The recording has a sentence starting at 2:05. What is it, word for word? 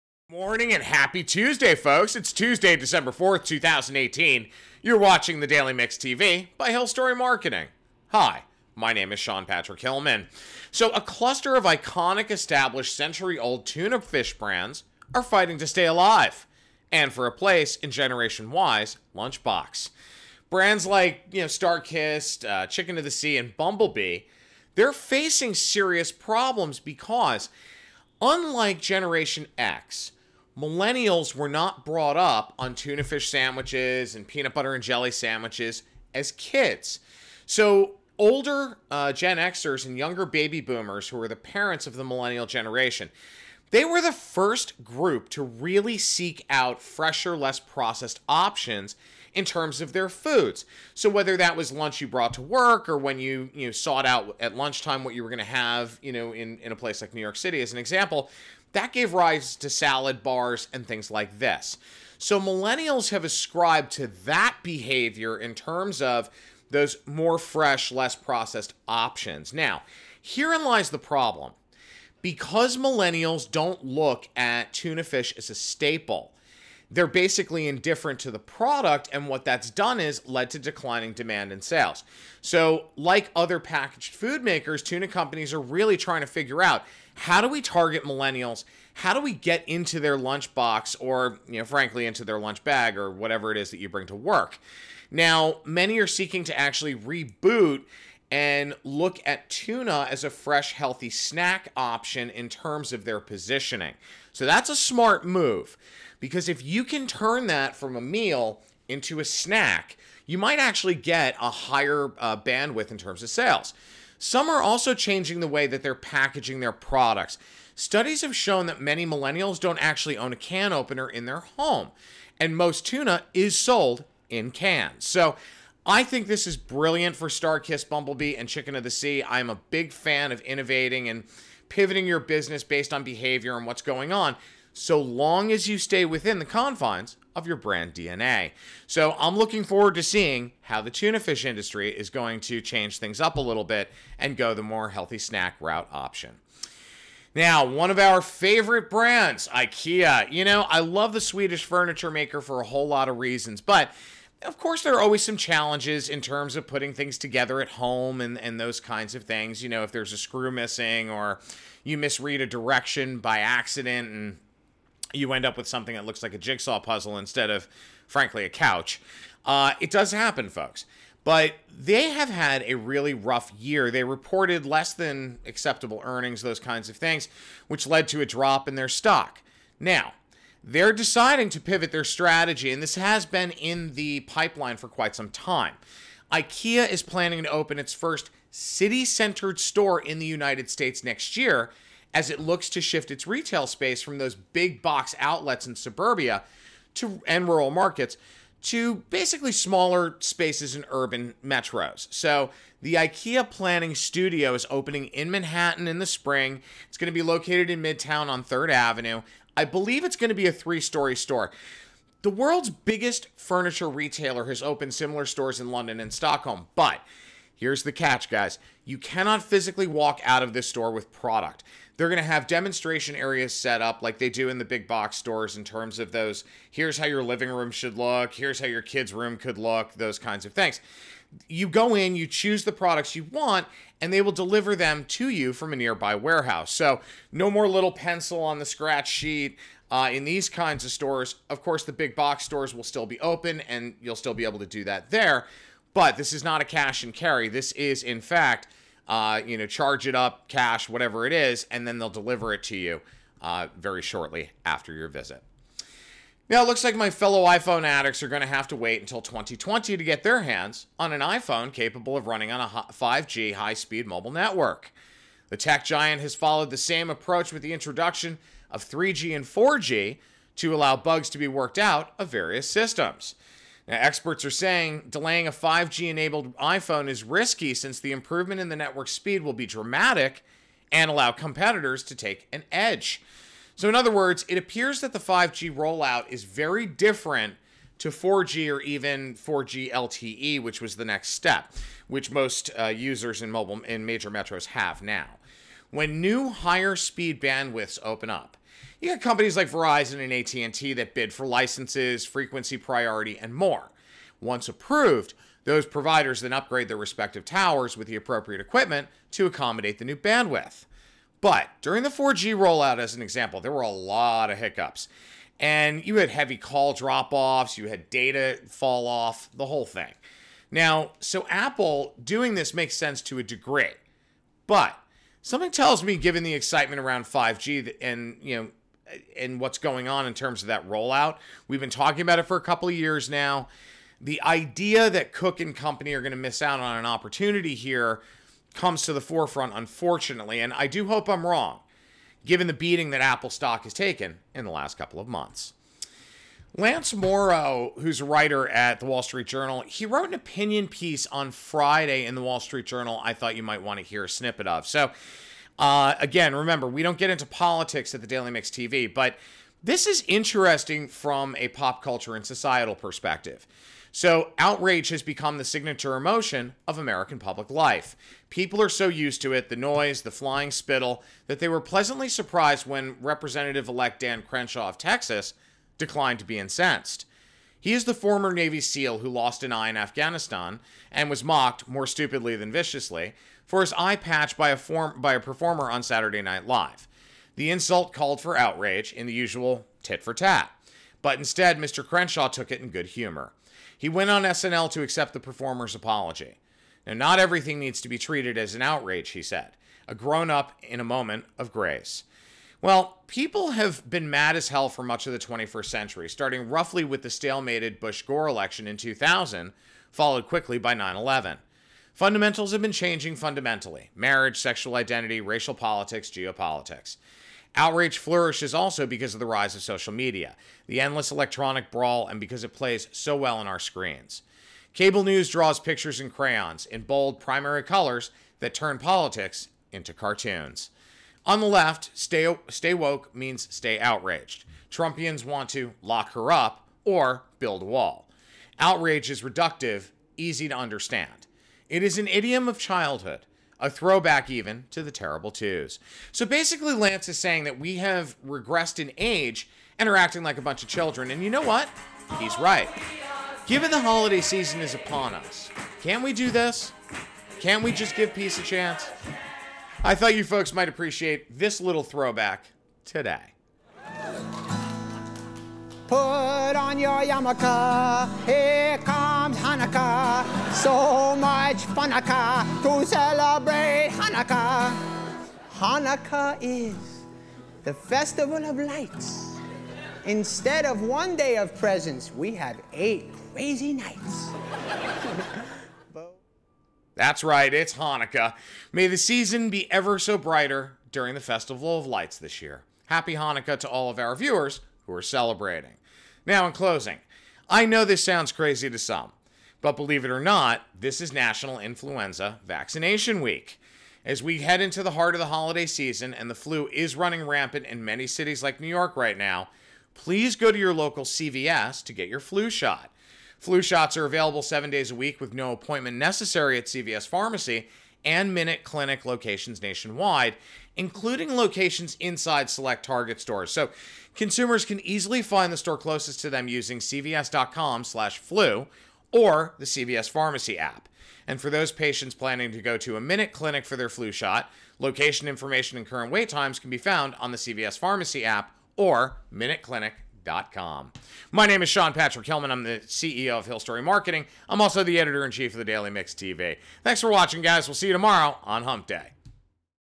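So I think this is brilliant for StarKist Bumblebee and Chicken of the Sea.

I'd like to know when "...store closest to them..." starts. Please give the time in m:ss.
8:45.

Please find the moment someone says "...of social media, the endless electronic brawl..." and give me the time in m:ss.
6:59.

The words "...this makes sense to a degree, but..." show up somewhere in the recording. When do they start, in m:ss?
5:22.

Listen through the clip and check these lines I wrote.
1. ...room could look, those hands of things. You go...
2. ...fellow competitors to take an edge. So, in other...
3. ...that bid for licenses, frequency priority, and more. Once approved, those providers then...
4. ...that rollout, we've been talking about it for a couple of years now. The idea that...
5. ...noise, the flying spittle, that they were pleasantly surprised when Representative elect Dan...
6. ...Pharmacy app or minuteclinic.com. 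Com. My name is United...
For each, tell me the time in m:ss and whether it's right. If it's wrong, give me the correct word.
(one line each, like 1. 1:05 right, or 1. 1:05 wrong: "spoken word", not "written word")
1. 3:49 wrong: "kinds", not "hands"
2. 4:41 wrong: "allow", not "fellow"
3. 5:00 right
4. 5:30 right
5. 6:09 right
6. 8:57 wrong: "Sean", not "United".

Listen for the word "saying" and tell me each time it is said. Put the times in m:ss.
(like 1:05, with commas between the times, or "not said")
4:34, 7:27.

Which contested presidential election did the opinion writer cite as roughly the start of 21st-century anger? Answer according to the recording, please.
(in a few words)
Bush Gore election.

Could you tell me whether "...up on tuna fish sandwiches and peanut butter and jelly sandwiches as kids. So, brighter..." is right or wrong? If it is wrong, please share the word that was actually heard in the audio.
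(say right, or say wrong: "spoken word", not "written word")
wrong: "older", not "brighter".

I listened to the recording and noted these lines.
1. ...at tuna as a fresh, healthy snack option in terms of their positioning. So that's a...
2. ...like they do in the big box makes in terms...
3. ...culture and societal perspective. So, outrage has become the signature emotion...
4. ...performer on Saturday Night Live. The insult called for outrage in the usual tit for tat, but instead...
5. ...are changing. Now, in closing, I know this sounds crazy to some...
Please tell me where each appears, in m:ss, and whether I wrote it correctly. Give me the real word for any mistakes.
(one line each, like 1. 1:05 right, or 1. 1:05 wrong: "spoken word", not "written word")
1. 1:39 right
2. 3:44 wrong: "stores", not "makes"
3. 6:02 right
4. 6:25 right
5. 8:15 wrong: "celebrating", not "changing".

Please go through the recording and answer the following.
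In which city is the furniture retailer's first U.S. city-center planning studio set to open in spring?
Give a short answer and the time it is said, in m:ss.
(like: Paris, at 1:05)
Manhattan, at 3:25.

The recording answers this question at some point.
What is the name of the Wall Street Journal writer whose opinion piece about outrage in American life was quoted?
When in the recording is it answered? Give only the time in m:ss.
5:46.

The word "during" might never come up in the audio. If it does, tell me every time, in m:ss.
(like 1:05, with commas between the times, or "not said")
5:11, 8:11.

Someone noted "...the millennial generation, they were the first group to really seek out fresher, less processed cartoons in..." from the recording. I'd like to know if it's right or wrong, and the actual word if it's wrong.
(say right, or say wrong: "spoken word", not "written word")
wrong: "options", not "cartoons".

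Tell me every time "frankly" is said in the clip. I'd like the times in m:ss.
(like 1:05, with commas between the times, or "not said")
1:31, 2:48.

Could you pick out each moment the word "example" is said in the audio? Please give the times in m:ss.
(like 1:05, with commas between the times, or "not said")
0:57, 5:13.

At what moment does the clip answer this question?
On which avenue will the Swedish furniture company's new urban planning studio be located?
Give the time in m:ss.
3:28.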